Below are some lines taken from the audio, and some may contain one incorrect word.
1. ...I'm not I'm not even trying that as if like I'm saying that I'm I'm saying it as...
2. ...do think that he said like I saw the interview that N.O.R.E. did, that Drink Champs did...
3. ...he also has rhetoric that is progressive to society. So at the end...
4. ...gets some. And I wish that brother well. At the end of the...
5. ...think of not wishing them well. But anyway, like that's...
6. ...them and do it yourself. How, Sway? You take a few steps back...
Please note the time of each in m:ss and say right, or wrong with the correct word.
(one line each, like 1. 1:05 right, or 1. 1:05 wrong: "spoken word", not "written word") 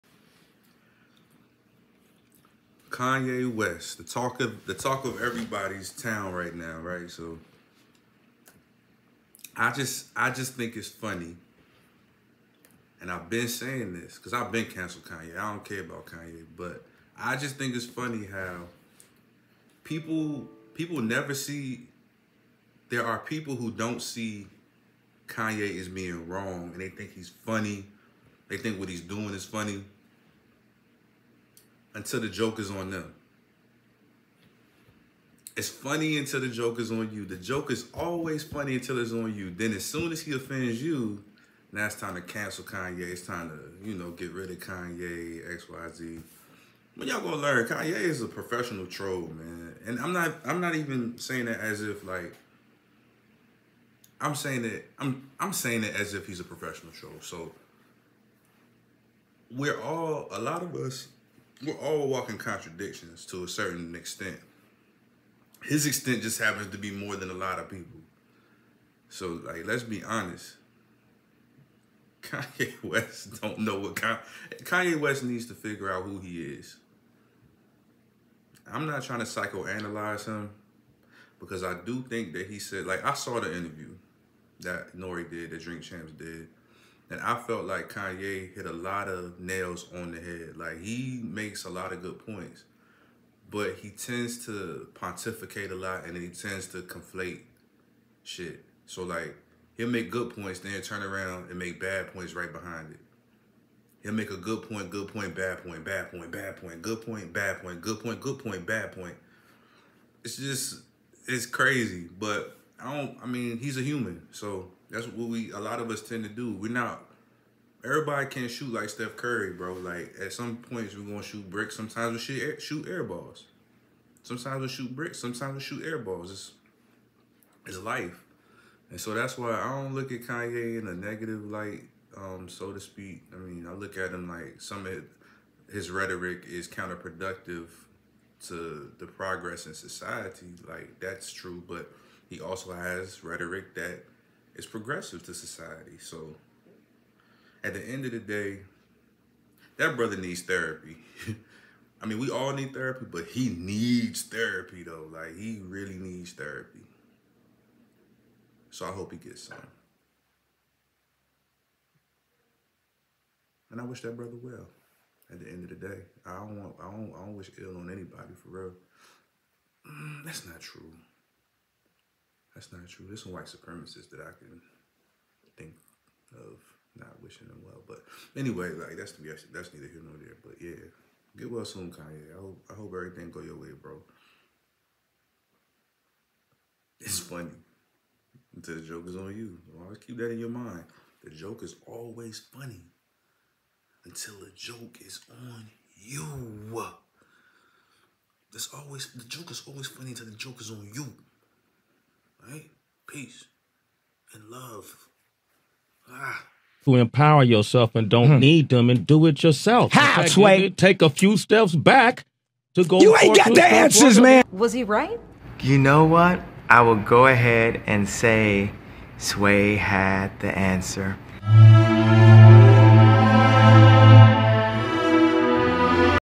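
1. 0:49 wrong: "saying", not "trying"
2. 1:21 right
3. 2:22 right
4. 2:39 right
5. 2:55 right
6. 3:28 right.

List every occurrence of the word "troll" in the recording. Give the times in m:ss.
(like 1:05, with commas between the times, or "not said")
0:48, 0:56.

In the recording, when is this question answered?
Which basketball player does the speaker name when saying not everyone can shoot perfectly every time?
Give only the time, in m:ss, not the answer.
1:58.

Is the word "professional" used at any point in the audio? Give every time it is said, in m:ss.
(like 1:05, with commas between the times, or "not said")
0:48, 0:56.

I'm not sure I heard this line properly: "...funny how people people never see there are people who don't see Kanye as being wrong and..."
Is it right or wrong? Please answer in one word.
right.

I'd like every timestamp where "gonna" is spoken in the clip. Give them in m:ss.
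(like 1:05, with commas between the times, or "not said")
0:47, 2:01.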